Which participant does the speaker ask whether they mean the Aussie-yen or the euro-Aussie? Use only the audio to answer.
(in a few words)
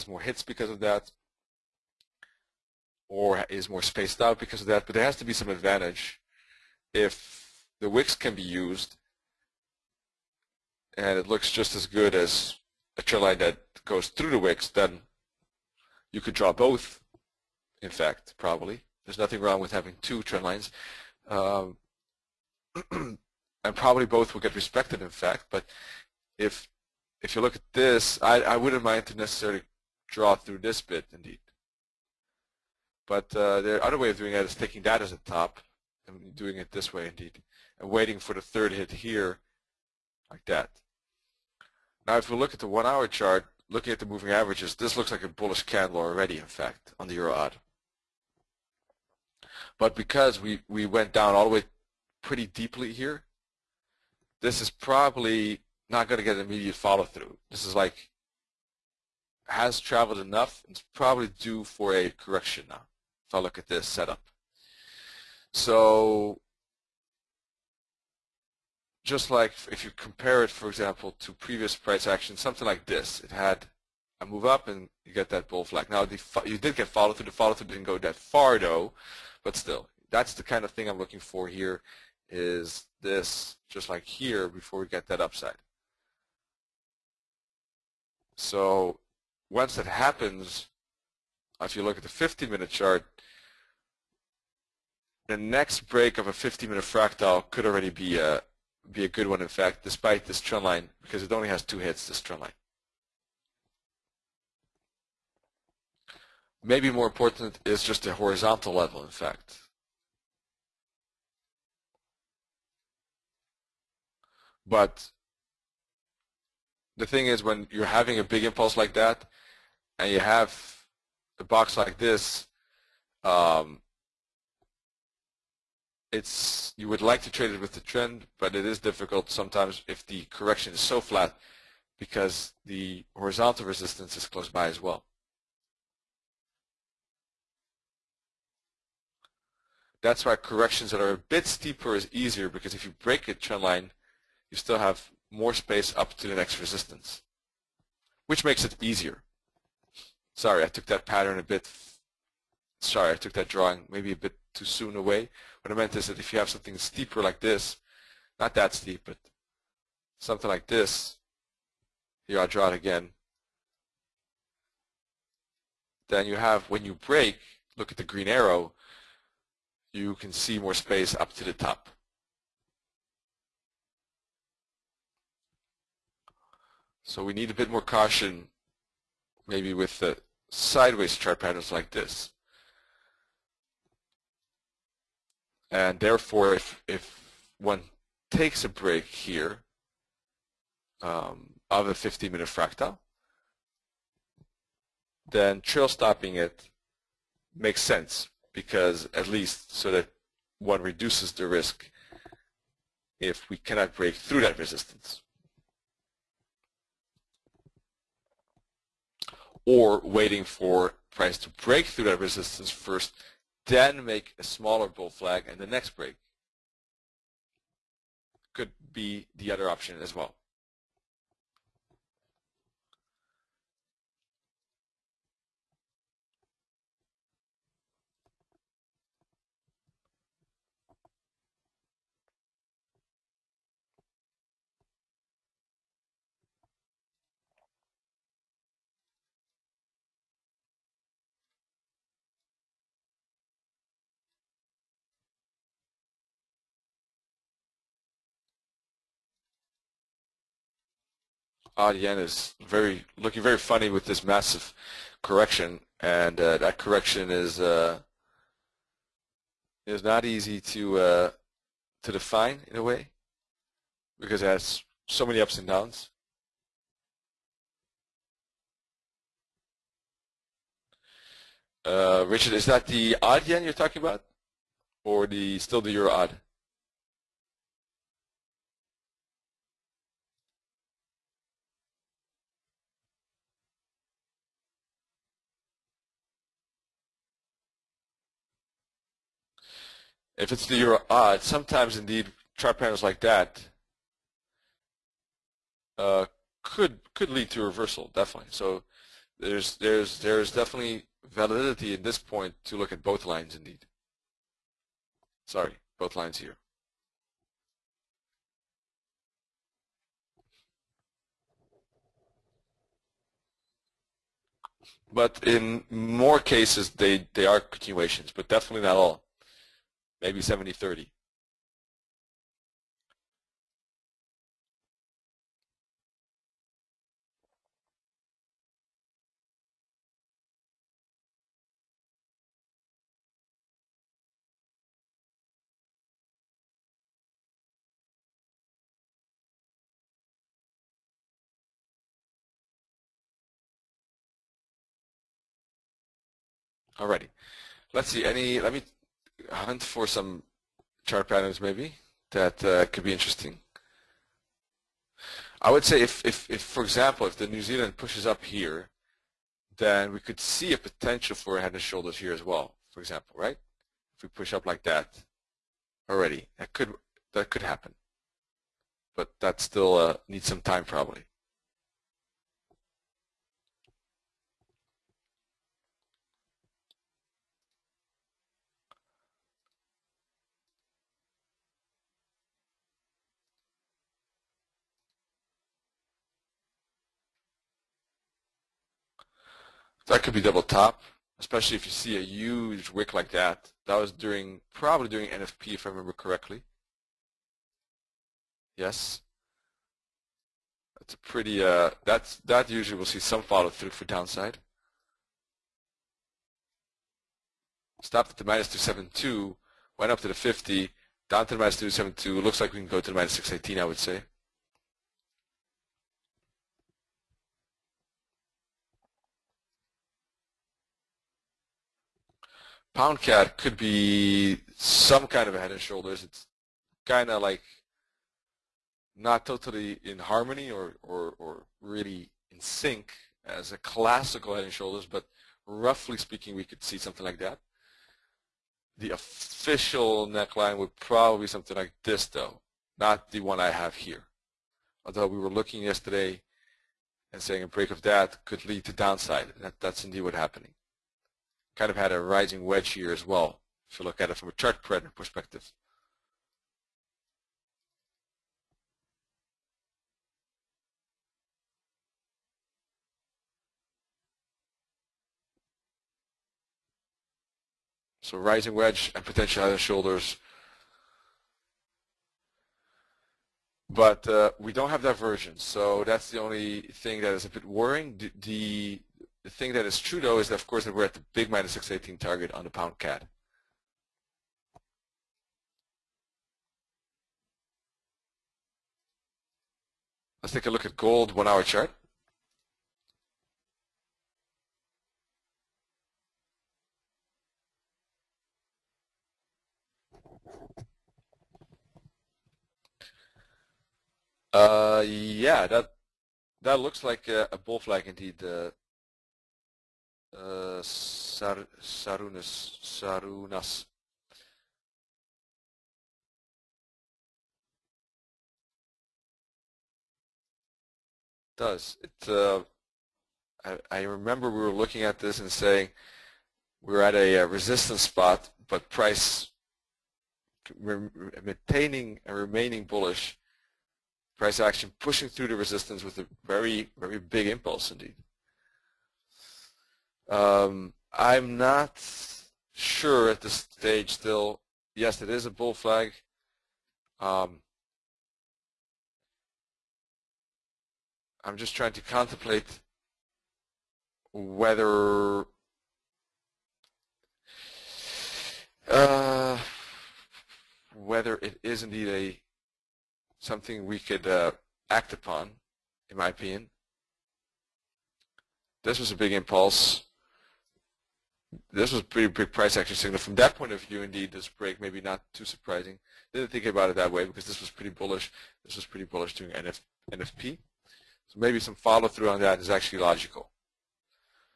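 Richard.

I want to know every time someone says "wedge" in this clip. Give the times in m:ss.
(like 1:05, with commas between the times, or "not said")
7:32, 7:48.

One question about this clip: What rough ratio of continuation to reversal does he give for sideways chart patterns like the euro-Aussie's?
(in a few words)
70-30.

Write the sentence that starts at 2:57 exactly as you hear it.
So we need a bit more caution maybe with the sideways chart patterns like this.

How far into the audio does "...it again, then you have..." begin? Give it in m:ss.
2:42.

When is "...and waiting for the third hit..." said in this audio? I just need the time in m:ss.
0:37.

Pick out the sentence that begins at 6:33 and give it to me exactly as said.
That was during, probably during NFP if I remember correctly.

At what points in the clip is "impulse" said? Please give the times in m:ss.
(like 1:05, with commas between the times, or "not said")
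1:58, 8:57, 9:29.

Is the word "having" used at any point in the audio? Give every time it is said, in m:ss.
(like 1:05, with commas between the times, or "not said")
0:19, 1:57.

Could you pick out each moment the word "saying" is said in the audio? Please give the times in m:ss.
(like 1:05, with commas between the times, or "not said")
7:27, 8:45.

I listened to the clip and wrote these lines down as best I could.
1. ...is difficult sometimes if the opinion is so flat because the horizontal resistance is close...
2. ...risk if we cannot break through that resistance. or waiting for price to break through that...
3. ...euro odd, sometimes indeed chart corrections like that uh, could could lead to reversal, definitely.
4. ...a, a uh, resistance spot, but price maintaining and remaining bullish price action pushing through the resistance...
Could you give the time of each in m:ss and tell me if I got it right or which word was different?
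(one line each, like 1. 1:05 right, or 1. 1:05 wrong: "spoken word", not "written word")
1. 2:08 wrong: "correction", not "opinion"
2. 3:21 right
3. 4:50 wrong: "patterns", not "corrections"
4. 8:47 right.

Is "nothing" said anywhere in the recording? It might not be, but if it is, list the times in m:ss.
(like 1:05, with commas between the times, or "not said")
0:19.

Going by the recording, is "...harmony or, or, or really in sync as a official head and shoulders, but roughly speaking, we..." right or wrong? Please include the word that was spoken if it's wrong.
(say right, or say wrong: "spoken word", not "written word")
wrong: "classical", not "official".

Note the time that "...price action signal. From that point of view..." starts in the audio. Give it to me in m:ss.
9:32.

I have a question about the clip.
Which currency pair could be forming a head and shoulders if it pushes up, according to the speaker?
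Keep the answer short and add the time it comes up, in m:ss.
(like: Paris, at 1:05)
New Zealand, at 5:57.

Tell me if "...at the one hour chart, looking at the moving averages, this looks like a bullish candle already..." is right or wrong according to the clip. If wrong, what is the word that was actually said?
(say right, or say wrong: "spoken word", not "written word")
right.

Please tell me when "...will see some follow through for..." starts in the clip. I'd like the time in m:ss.
6:42.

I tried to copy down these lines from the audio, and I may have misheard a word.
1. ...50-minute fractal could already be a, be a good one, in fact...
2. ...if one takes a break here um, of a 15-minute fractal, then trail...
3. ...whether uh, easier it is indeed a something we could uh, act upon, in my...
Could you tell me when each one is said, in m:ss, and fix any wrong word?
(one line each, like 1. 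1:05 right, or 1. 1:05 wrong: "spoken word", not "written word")
1. 1:36 right
2. 3:06 right
3. 9:14 wrong: "whether", not "easier".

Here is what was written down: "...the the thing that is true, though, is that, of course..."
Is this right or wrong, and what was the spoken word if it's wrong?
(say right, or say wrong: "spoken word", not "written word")
right.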